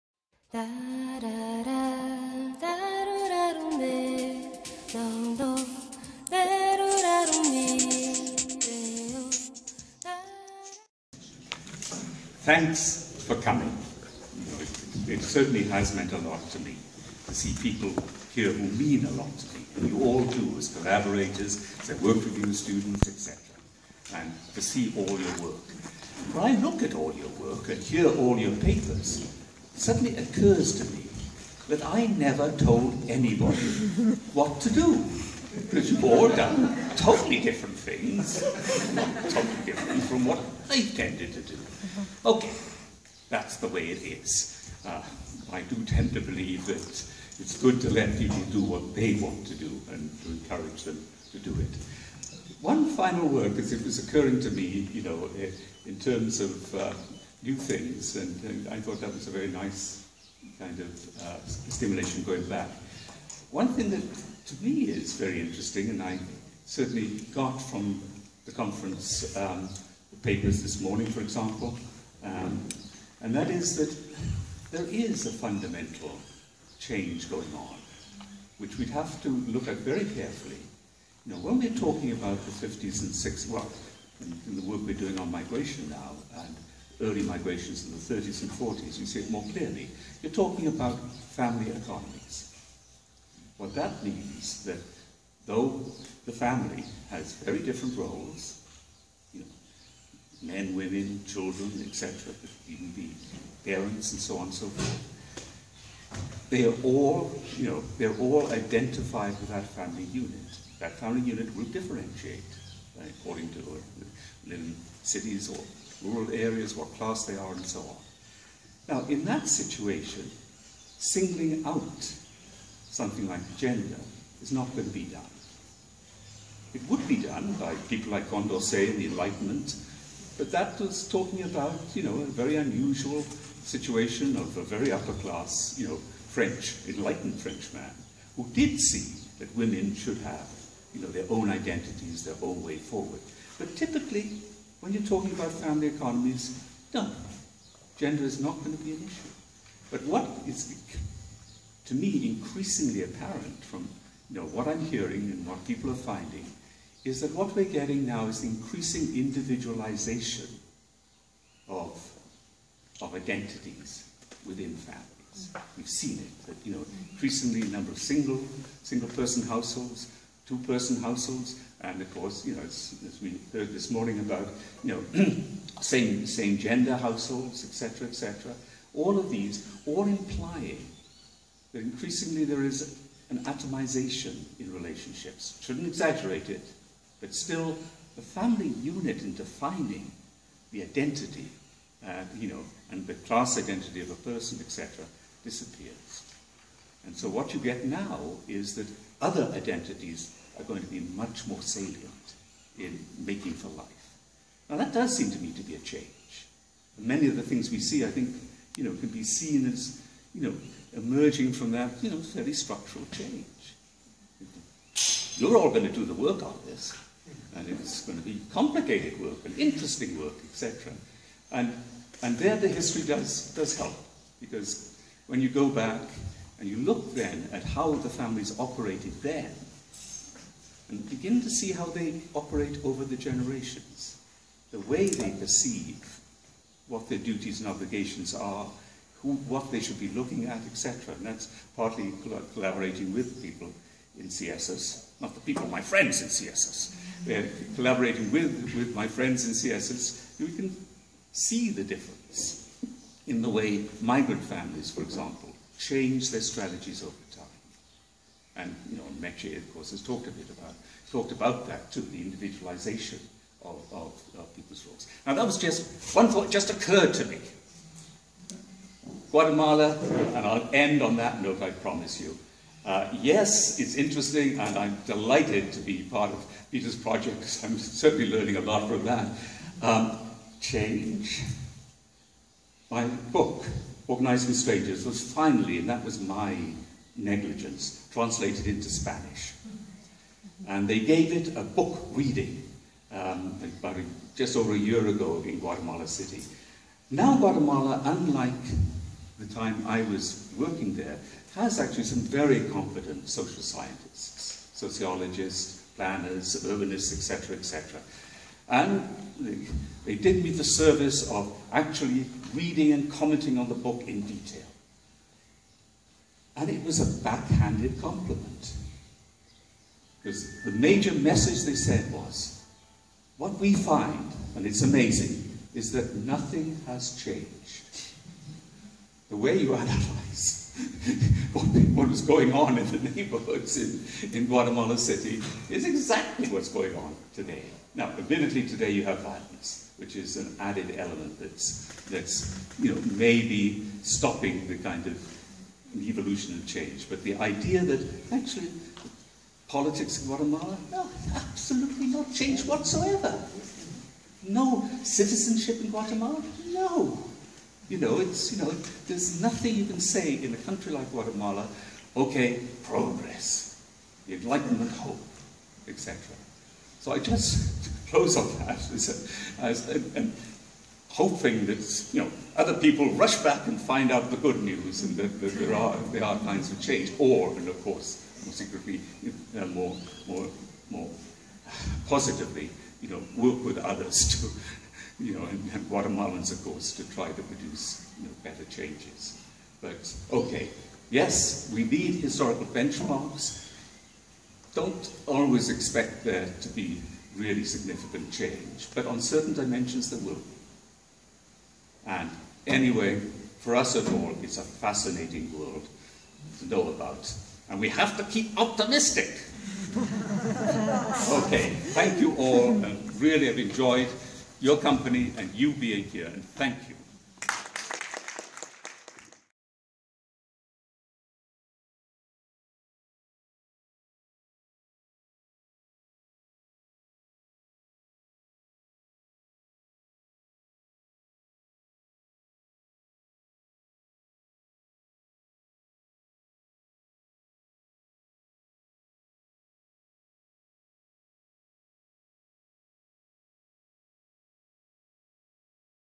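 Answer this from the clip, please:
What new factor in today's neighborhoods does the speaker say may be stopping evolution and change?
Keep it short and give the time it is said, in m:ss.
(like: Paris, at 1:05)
Violence, at 5:39.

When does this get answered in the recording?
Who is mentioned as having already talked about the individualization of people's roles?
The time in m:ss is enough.
4:19.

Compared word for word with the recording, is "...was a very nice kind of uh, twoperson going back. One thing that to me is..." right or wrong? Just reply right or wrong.
wrong.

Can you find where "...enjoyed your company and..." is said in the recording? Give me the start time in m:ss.
6:53.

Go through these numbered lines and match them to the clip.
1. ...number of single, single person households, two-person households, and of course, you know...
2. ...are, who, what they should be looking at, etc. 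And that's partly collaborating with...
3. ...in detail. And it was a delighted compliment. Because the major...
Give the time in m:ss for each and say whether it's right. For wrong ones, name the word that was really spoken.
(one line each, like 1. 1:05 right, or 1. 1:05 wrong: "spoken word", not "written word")
1. 2:47 right
2. 3:58 right
3. 5:14 wrong: "backhanded", not "delighted".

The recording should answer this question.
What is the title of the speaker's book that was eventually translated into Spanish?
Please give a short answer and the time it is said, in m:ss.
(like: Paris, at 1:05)
Organizing Strangers, at 4:44.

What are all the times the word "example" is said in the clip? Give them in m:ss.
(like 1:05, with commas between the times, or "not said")
1:11, 4:15.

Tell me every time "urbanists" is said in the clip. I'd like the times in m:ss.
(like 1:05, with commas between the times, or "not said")
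5:06.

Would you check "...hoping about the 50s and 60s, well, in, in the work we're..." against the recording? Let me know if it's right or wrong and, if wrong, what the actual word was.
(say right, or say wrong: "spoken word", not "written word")
wrong: "talking", not "hoping".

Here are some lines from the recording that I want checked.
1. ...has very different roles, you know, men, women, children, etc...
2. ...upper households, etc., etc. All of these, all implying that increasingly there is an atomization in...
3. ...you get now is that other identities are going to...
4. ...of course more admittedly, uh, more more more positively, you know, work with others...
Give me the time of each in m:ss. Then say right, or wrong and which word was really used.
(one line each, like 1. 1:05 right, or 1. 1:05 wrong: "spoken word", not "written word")
1. 1:37 right
2. 2:56 wrong: "gender", not "upper"
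3. 3:17 right
4. 6:17 wrong: "secretly", not "admittedly".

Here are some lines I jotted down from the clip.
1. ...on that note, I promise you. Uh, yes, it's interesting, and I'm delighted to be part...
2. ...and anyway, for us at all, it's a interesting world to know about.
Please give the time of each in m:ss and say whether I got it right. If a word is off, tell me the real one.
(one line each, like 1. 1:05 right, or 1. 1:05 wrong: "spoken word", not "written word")
1. 4:31 right
2. 6:42 wrong: "fascinating", not "interesting".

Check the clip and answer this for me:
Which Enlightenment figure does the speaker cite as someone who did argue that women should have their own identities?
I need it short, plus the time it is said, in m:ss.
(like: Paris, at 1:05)
Condorcet, at 2:08.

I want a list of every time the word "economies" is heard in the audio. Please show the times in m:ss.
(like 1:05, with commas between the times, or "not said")
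1:31, 2:25.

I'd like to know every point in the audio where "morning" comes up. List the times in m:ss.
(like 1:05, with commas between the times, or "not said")
1:10, 2:53.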